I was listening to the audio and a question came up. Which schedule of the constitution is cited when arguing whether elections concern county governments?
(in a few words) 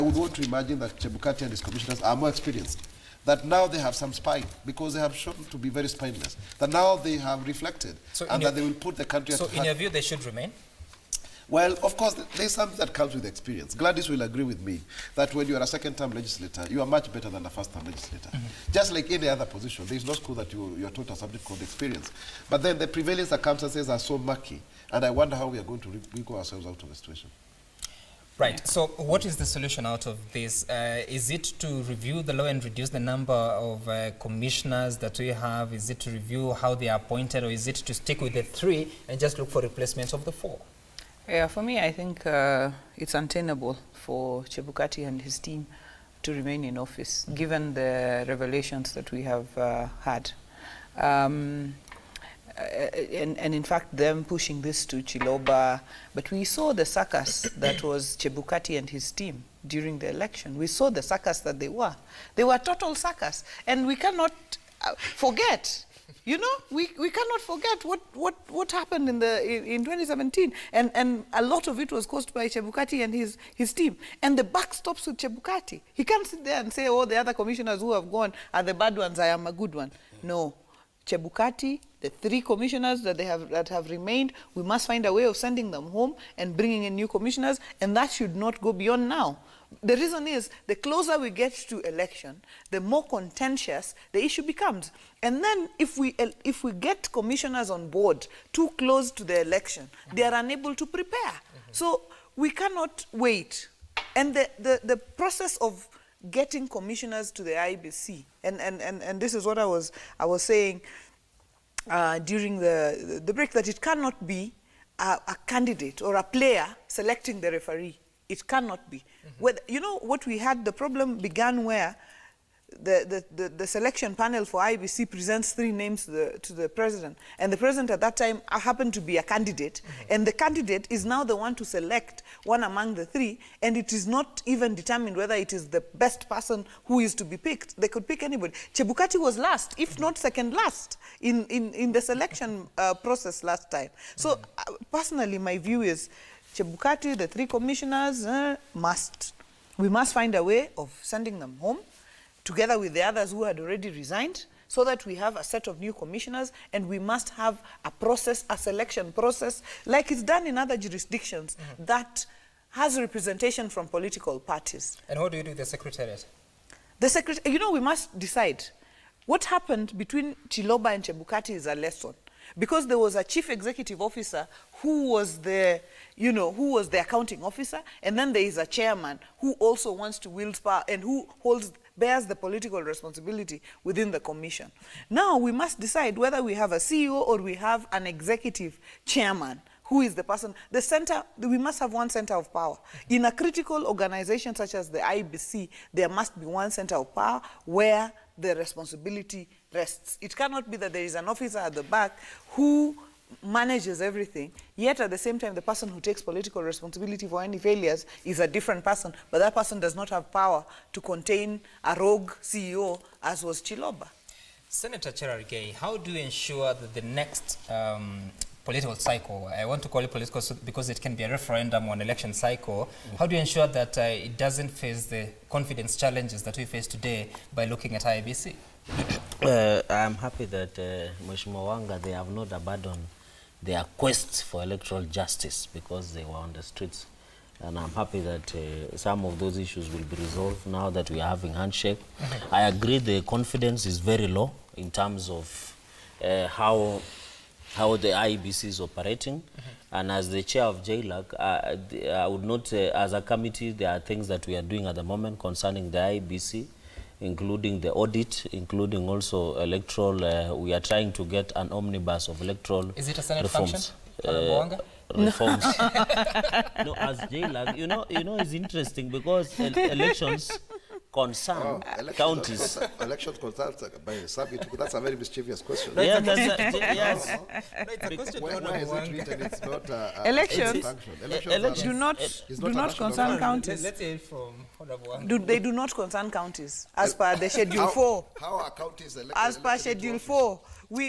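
Schedule 4.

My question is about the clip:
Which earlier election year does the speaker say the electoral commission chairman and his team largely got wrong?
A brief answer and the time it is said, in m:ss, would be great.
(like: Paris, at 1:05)
2017, at 1:09.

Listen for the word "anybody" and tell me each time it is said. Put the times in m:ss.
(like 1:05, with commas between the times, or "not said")
2:18.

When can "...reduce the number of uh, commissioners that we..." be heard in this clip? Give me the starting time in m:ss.
0:32.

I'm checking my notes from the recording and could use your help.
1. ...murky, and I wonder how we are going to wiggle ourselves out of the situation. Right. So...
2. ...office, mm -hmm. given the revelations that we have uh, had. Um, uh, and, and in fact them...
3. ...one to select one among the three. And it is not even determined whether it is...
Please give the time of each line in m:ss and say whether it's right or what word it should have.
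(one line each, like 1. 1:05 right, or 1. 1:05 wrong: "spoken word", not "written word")
1. 0:24 right
2. 0:46 right
3. 2:11 right.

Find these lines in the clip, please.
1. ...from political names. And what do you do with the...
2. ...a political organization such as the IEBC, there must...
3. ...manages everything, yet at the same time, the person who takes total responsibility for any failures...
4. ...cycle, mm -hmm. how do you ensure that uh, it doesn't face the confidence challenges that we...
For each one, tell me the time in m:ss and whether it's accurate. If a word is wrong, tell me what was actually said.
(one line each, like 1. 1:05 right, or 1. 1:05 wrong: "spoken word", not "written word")
1. 2:43 wrong: "parties", not "names"
2. 3:13 wrong: "critical", not "political"
3. 3:23 wrong: "political", not "total"
4. 3:42 right.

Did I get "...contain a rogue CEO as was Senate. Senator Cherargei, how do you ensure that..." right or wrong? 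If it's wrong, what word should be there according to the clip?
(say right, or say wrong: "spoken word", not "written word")
wrong: "Chiloba", not "Senate".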